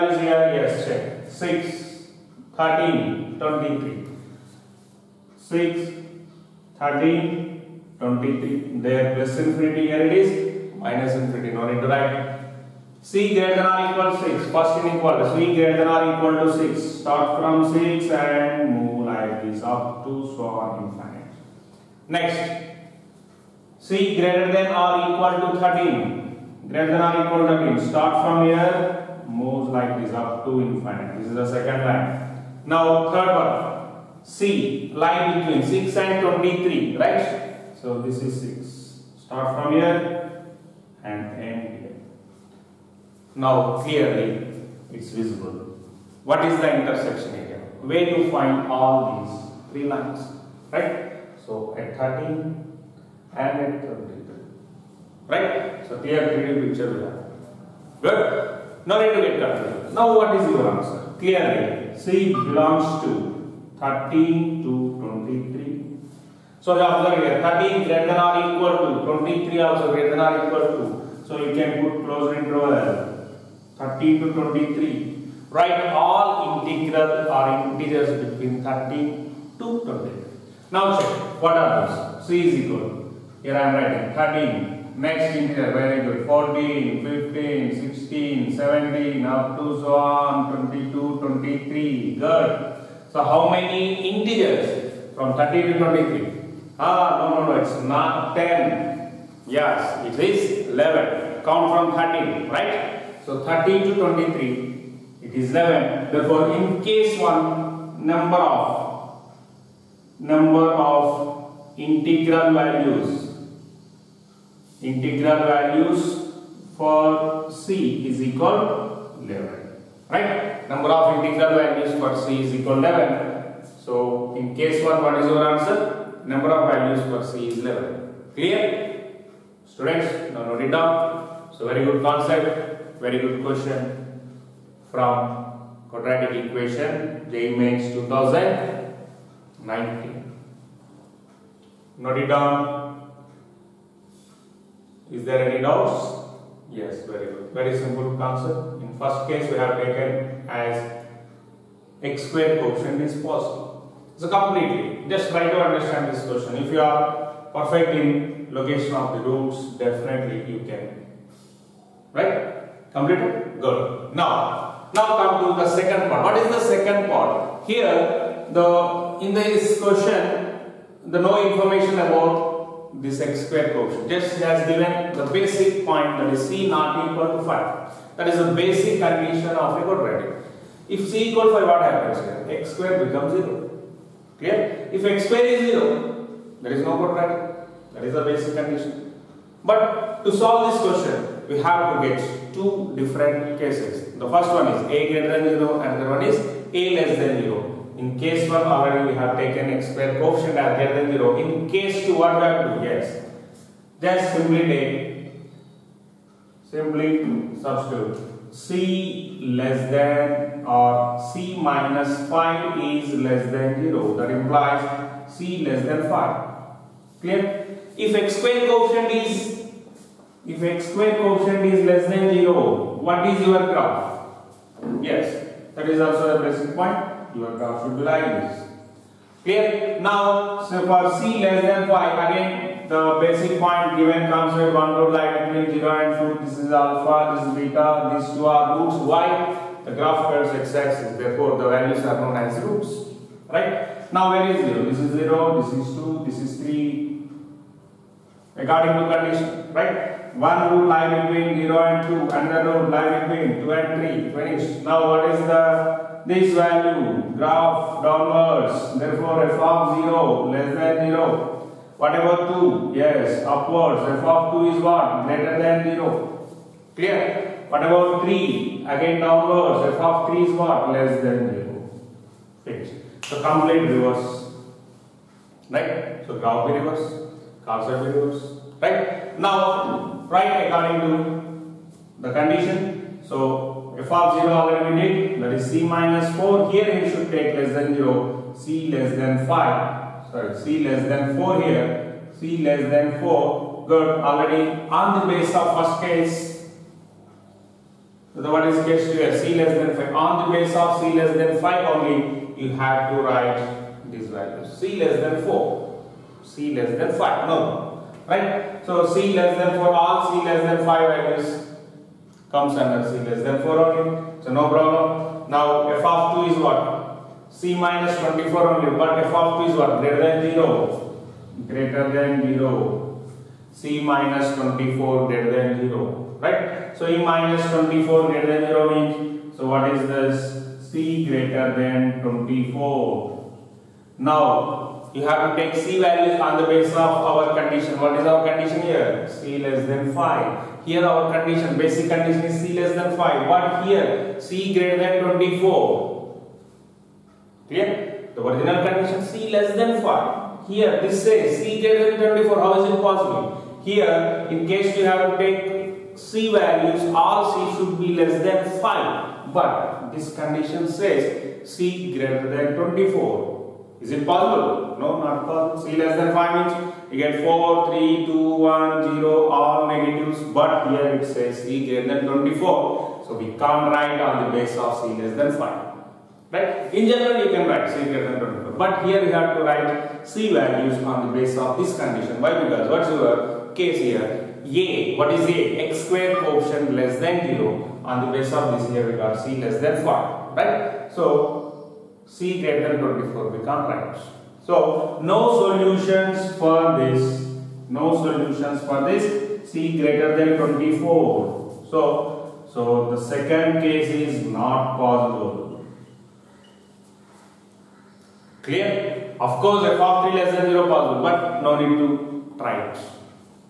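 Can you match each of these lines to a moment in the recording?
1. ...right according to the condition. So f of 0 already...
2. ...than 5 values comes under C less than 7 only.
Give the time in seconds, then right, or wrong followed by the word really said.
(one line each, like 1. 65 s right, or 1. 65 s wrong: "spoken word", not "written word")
1. 280 s right
2. 310 s wrong: "4", not "7".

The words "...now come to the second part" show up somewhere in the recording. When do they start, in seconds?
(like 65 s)
164 s.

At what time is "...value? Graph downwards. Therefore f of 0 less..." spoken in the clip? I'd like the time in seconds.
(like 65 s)
256 s.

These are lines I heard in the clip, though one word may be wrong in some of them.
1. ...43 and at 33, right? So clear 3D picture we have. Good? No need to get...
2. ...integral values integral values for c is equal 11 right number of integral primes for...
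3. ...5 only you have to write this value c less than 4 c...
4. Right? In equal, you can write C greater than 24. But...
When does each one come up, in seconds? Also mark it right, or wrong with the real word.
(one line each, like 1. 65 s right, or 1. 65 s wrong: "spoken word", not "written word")
1. 51 s wrong: "13", not "43"
2. 111 s wrong: "values", not "primes"
3. 301 s right
4. 376 s wrong: "general", not "equal".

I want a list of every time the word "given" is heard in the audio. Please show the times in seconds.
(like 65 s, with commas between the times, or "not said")
174 s, 233 s.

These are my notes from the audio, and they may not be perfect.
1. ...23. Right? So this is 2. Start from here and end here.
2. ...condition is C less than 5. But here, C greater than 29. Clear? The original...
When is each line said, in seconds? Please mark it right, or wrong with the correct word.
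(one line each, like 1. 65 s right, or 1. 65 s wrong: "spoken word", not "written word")
1. 36 s wrong: "6", not "2"
2. 342 s wrong: "24", not "29".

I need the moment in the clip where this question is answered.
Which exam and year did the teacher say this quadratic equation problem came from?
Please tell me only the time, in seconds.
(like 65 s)
137 s.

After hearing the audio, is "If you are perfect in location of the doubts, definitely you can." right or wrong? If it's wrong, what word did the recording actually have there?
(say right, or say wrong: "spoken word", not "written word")
wrong: "roots", not "doubts".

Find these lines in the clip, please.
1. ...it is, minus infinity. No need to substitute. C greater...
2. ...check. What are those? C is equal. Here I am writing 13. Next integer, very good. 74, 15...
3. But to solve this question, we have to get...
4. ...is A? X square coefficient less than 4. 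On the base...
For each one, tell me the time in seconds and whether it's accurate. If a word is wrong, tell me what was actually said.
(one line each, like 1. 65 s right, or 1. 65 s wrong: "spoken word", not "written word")
1. 10 s wrong: "write", not "substitute"
2. 80 s wrong: "14", not "74"
3. 189 s right
4. 385 s wrong: "0", not "4".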